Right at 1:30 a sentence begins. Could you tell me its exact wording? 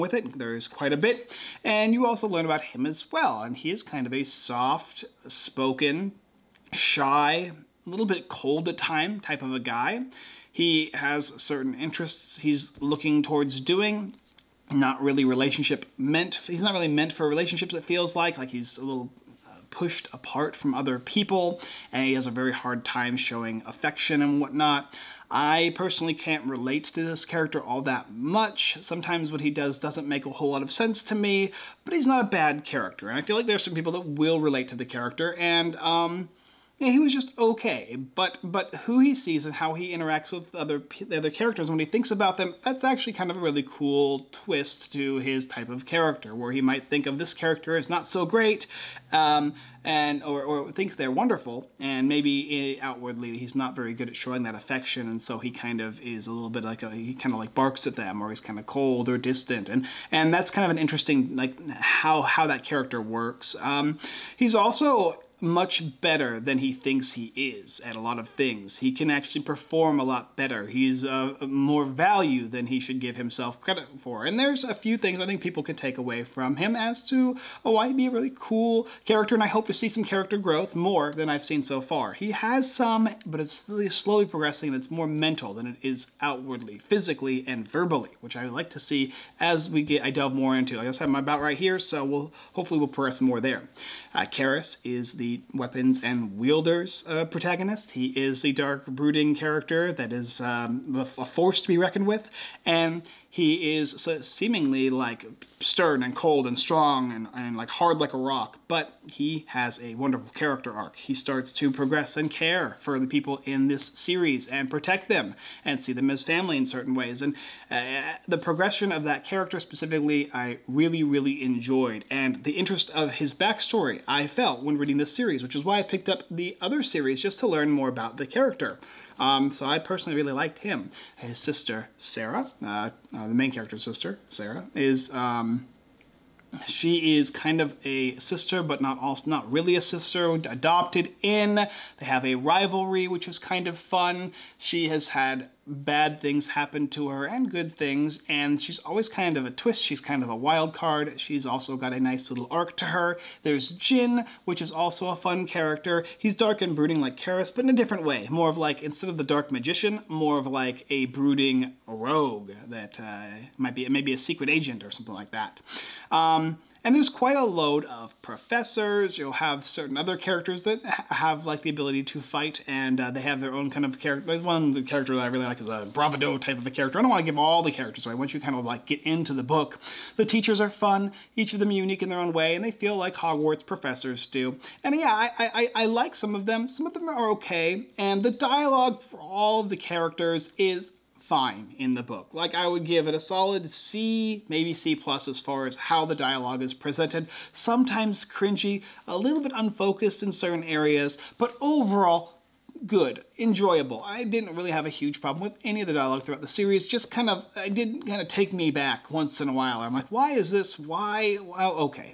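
I just I'm about right here, so we'll hopefully we'll progress more there.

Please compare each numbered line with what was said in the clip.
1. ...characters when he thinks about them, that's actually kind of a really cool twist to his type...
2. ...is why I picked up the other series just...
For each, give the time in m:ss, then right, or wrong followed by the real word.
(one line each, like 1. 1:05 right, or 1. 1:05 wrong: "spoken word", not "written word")
1. 0:41 right
2. 2:05 right.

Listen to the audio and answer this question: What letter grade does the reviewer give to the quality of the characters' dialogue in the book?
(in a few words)
C plus.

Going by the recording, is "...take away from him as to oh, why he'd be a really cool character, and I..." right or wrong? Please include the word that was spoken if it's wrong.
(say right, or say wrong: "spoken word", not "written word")
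right.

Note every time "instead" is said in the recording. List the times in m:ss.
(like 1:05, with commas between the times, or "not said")
2:38.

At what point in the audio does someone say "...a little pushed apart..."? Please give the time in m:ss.
0:18.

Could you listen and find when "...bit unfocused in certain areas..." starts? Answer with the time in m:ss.
3:19.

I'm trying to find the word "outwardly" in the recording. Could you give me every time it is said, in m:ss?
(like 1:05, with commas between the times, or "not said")
0:52, 1:26.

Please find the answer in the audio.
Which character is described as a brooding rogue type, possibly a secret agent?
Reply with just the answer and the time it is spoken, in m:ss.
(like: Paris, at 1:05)
Jin, at 2:33.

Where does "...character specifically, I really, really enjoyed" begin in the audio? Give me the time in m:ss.
1:59.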